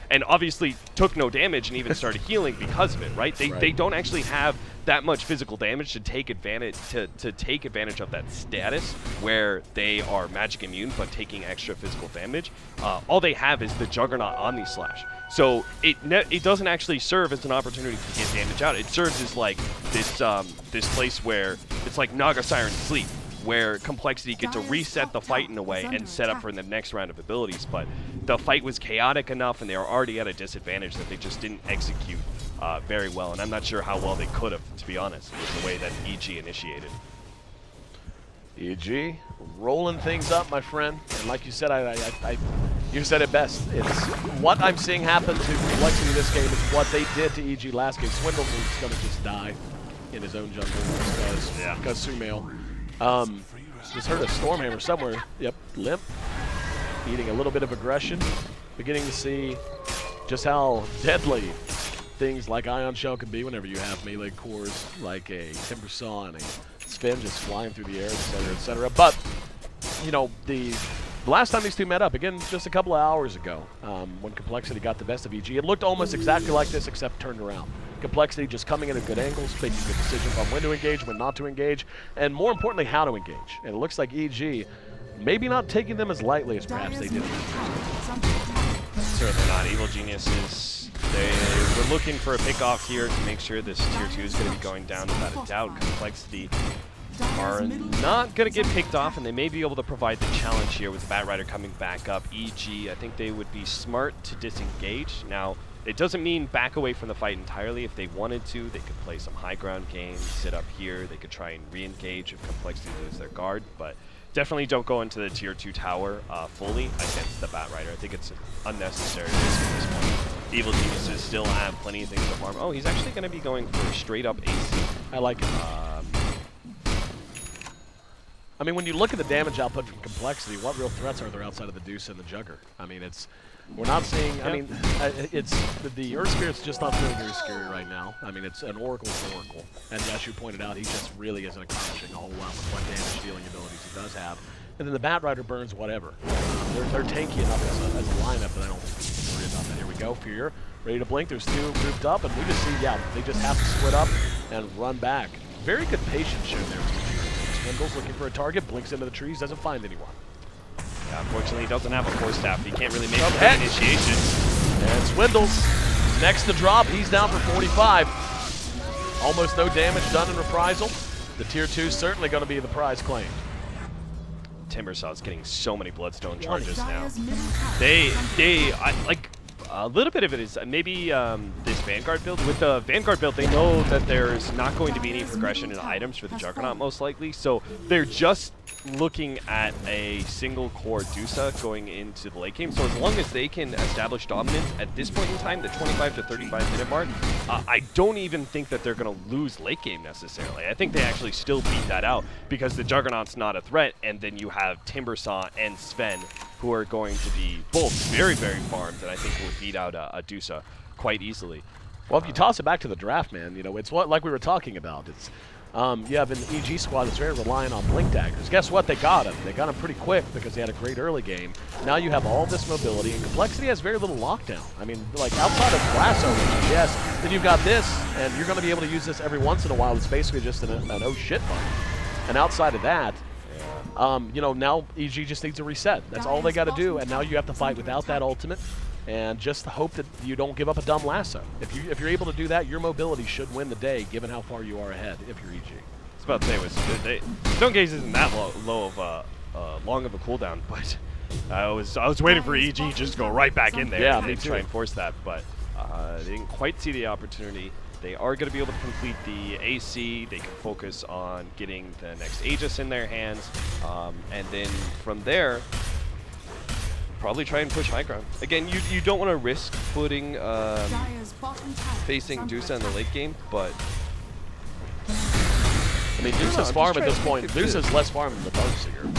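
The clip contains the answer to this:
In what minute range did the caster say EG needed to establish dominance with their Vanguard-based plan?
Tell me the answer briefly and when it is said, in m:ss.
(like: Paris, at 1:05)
25 to 35 minutes, at 3:15.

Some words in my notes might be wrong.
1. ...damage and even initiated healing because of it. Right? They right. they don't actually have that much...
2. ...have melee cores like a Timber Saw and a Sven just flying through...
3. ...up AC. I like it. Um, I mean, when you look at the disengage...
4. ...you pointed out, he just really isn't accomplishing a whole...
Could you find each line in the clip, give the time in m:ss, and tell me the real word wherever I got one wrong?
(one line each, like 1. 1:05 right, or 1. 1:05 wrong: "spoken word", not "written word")
1. 0:01 wrong: "started", not "initiated"
2. 1:03 right
3. 2:04 wrong: "damage", not "disengage"
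4. 2:20 right.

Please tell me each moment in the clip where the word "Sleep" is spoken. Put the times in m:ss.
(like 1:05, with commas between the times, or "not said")
0:22.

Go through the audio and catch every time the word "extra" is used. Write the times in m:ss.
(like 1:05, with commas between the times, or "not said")
0:11.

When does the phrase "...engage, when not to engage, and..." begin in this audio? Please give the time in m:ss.
1:20.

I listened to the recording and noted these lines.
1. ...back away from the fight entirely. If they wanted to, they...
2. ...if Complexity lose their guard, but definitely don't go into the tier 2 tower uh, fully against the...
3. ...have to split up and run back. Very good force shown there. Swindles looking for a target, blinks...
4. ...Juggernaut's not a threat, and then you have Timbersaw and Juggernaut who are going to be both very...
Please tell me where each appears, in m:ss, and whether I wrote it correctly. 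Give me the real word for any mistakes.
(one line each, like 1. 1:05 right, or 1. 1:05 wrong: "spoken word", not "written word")
1. 1:46 right
2. 1:52 right
3. 2:33 wrong: "patience", not "force"
4. 3:22 wrong: "Sven", not "Juggernaut".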